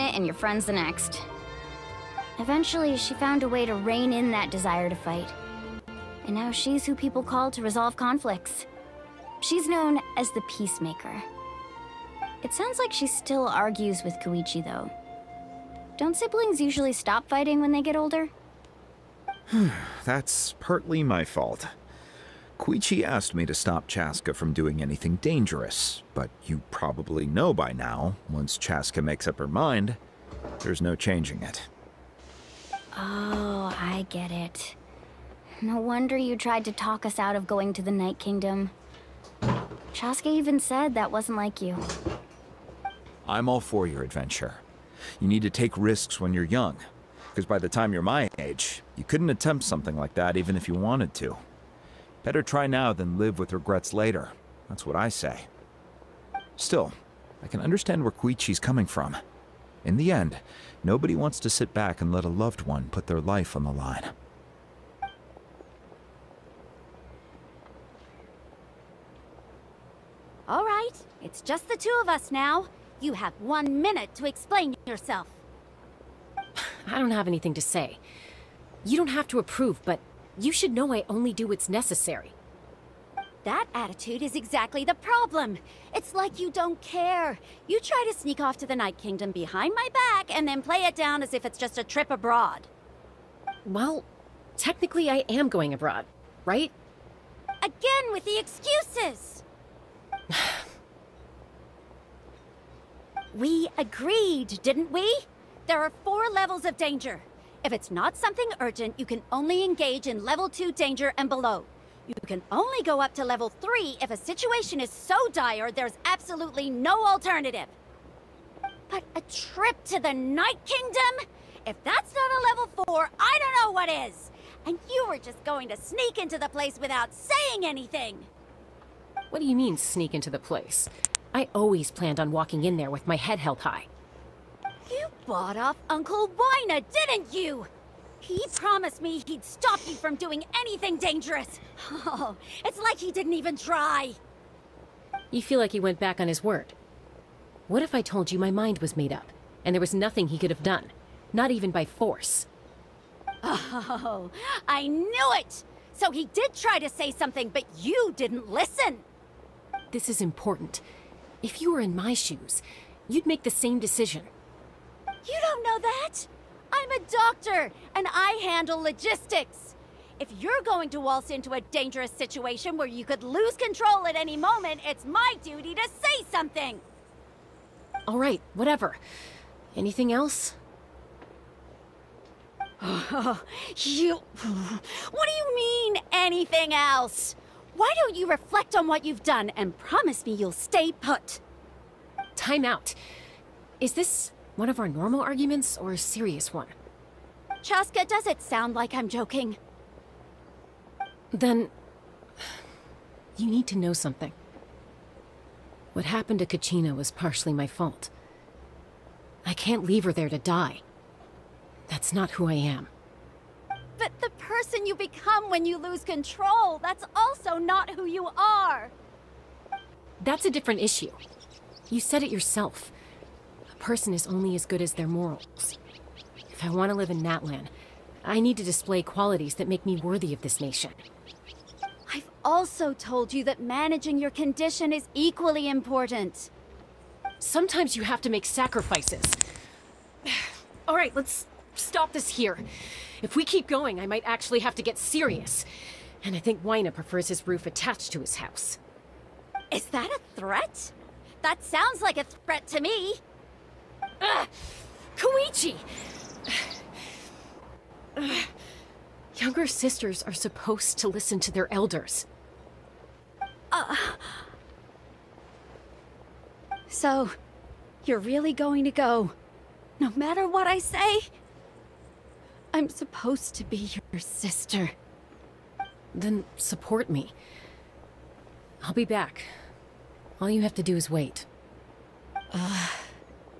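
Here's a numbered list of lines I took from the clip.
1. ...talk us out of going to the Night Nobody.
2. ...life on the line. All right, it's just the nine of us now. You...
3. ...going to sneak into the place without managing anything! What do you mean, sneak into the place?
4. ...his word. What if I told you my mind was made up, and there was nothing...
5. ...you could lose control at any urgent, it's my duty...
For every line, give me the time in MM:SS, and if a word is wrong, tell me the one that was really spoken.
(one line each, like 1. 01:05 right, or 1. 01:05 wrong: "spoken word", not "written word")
1. 00:36 wrong: "Kingdom", not "Nobody"
2. 01:03 wrong: "two", not "nine"
3. 02:05 wrong: "saying", not "managing"
4. 02:26 right
5. 02:52 wrong: "moment", not "urgent".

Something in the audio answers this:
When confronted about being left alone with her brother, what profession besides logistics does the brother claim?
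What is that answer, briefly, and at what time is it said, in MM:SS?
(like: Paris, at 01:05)
doctor, at 02:46.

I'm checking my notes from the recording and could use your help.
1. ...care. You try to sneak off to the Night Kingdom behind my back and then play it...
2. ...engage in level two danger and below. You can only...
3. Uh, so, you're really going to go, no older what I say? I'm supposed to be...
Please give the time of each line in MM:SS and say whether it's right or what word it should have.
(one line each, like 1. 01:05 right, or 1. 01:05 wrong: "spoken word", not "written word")
1. 01:26 right
2. 01:49 right
3. 04:23 wrong: "matter", not "older".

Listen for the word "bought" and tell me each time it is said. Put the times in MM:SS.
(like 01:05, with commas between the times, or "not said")
02:15.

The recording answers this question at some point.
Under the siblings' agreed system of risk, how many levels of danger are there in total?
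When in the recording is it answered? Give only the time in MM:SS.
01:46.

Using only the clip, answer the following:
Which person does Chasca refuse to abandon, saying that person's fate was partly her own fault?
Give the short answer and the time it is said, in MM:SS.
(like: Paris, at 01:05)
Kachina, at 03:26.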